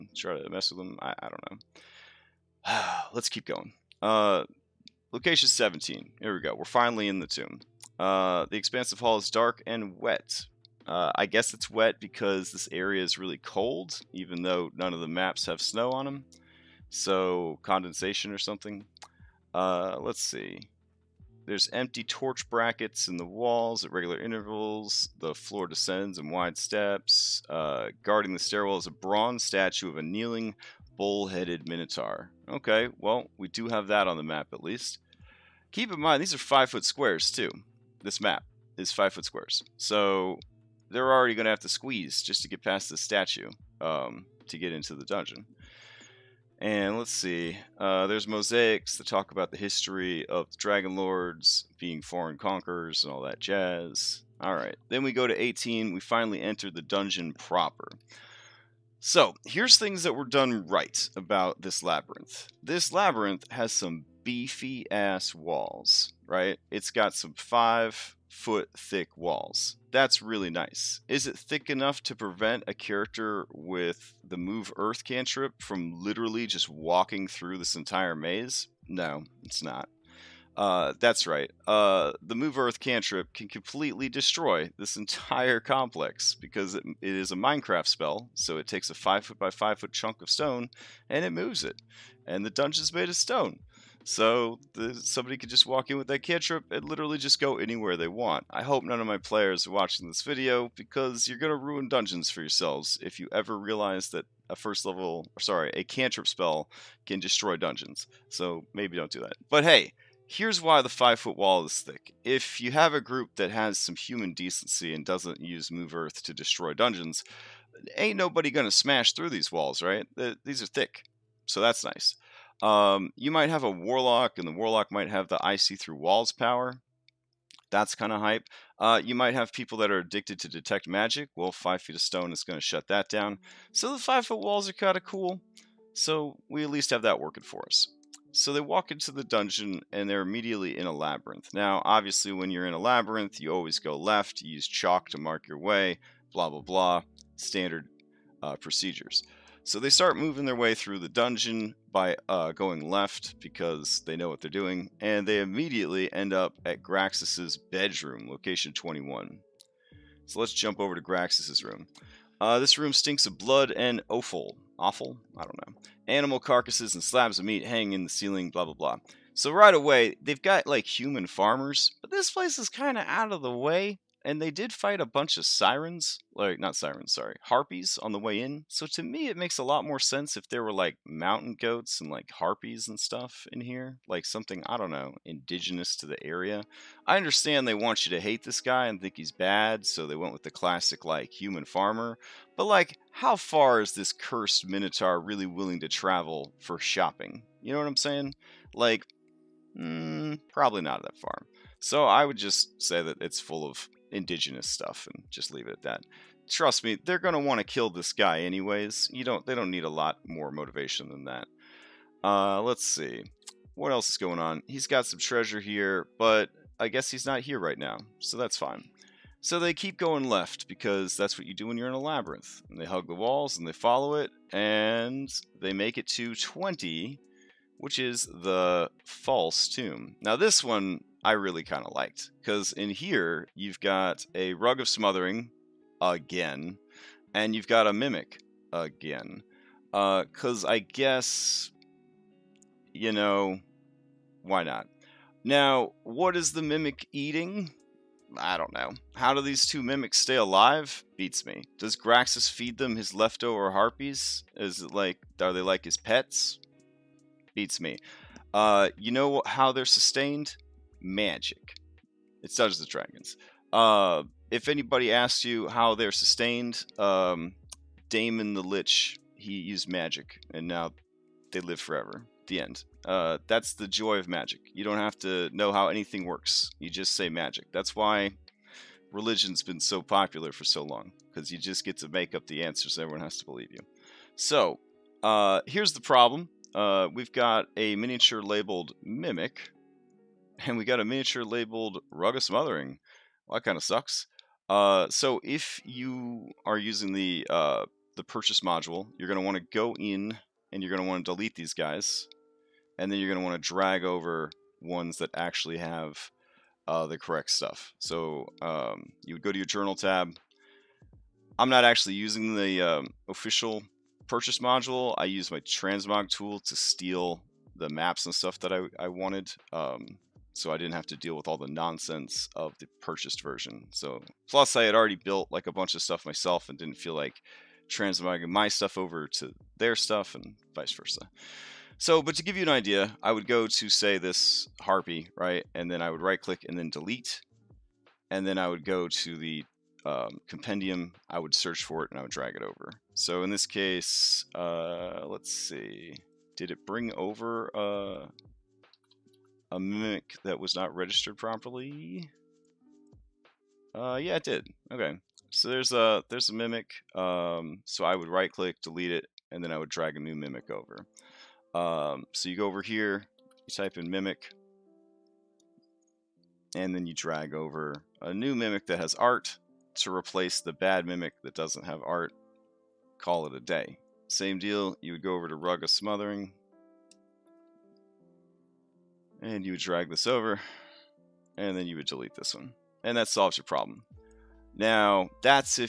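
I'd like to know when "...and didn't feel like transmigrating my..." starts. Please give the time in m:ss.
5:26.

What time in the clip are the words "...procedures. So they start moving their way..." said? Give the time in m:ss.
2:28.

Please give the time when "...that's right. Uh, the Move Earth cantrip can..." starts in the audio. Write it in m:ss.
1:20.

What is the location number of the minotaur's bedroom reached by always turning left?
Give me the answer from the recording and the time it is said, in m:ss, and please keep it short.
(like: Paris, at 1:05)
21, at 2:38.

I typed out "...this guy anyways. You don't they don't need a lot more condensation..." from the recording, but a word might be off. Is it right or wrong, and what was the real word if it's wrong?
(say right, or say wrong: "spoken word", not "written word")
wrong: "motivation", not "condensation".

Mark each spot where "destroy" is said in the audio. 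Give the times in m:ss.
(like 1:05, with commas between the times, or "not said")
1:24, 1:47, 1:56.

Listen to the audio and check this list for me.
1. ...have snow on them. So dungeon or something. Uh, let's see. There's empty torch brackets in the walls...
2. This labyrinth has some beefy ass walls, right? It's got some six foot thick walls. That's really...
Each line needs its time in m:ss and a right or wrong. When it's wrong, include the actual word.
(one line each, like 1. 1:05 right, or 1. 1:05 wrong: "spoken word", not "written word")
1. 0:15 wrong: "condensation", not "dungeon"
2. 1:02 wrong: "five", not "six".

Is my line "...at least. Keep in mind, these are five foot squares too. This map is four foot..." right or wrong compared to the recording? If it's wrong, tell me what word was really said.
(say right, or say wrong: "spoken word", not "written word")
wrong: "five", not "four".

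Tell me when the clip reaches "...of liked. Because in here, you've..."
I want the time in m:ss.
3:51.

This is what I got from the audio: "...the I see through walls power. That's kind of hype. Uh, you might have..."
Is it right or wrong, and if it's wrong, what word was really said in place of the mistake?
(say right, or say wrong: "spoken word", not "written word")
right.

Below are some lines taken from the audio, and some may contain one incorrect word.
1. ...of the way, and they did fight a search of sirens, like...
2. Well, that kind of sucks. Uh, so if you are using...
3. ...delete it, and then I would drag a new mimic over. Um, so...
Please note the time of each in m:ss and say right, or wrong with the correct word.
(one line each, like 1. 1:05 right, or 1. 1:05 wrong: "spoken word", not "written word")
1. 2:53 wrong: "bunch", not "search"
2. 4:53 right
3. 5:58 right.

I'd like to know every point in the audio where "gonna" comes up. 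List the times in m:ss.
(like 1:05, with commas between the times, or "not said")
1:58.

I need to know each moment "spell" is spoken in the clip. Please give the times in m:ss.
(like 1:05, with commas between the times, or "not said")
1:27, 1:46.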